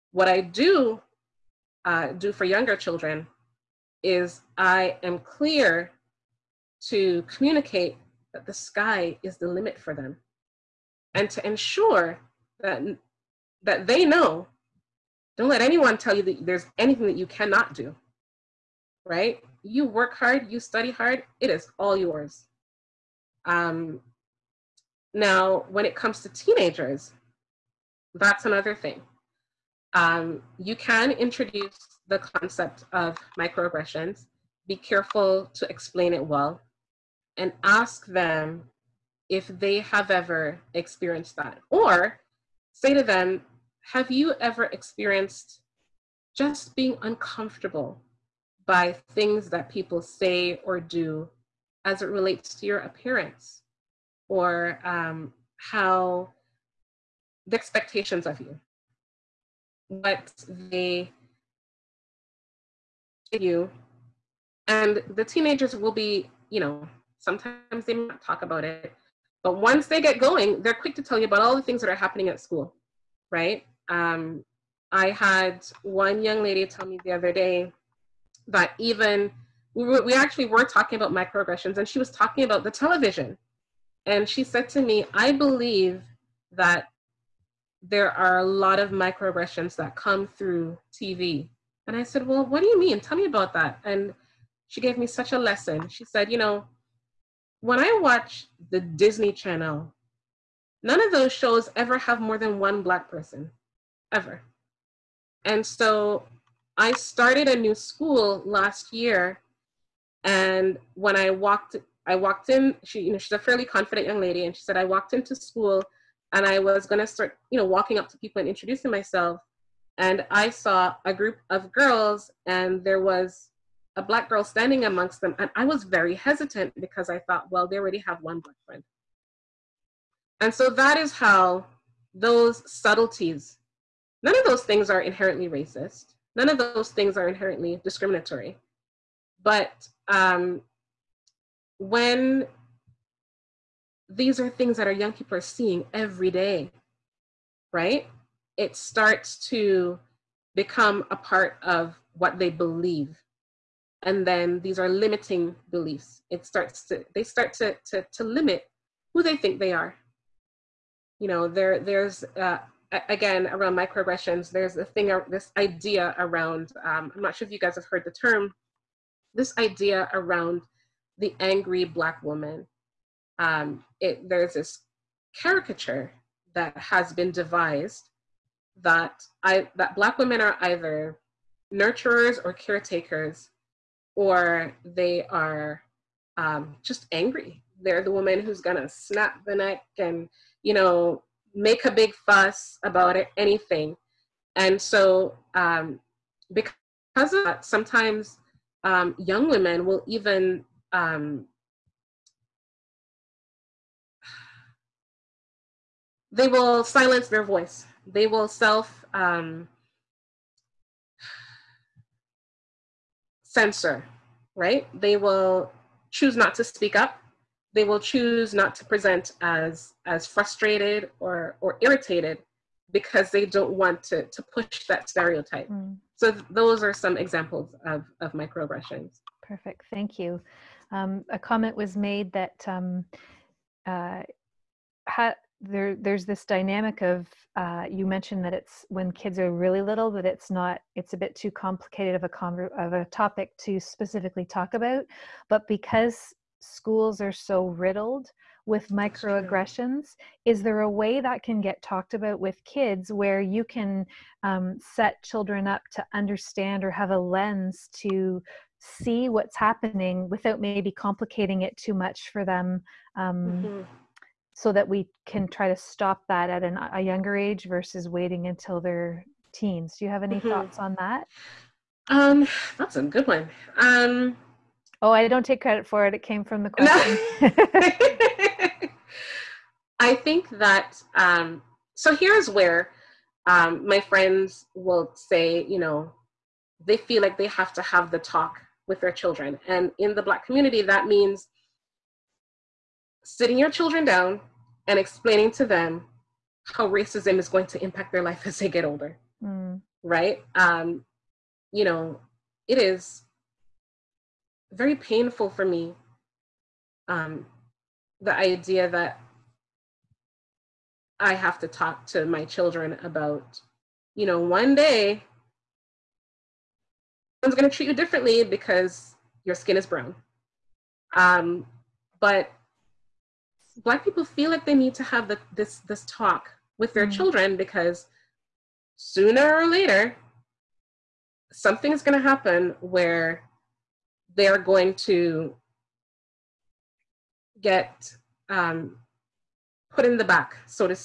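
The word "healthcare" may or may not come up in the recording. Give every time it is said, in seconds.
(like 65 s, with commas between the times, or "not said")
not said.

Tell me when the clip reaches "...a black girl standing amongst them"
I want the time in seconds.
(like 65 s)
123 s.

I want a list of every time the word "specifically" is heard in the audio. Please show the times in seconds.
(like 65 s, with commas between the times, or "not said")
243 s.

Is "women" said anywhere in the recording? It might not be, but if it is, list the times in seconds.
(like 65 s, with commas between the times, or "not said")
180 s, 199 s.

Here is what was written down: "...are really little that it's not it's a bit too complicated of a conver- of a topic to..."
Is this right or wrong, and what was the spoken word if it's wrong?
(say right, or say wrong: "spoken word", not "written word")
right.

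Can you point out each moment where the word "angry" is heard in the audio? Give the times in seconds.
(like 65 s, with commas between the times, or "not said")
171 s, 187 s.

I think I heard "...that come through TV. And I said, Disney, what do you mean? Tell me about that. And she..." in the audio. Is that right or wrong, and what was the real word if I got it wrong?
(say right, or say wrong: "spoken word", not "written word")
wrong: "Well", not "Disney".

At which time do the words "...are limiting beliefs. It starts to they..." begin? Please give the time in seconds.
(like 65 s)
154 s.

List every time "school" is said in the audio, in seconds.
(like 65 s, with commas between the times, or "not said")
72 s, 107 s, 115 s, 246 s.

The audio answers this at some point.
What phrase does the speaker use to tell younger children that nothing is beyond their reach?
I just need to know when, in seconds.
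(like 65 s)
8 s.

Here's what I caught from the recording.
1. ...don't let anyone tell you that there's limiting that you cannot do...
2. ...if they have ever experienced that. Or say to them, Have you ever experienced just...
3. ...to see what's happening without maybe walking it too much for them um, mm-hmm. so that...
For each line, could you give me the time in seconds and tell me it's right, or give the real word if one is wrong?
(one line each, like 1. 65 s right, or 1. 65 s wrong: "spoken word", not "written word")
1. 15 s wrong: "anything", not "limiting"
2. 39 s right
3. 257 s wrong: "complicating", not "walking".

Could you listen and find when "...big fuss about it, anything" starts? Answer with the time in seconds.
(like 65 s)
191 s.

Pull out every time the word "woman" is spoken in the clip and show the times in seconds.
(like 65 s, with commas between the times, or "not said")
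172 s, 188 s.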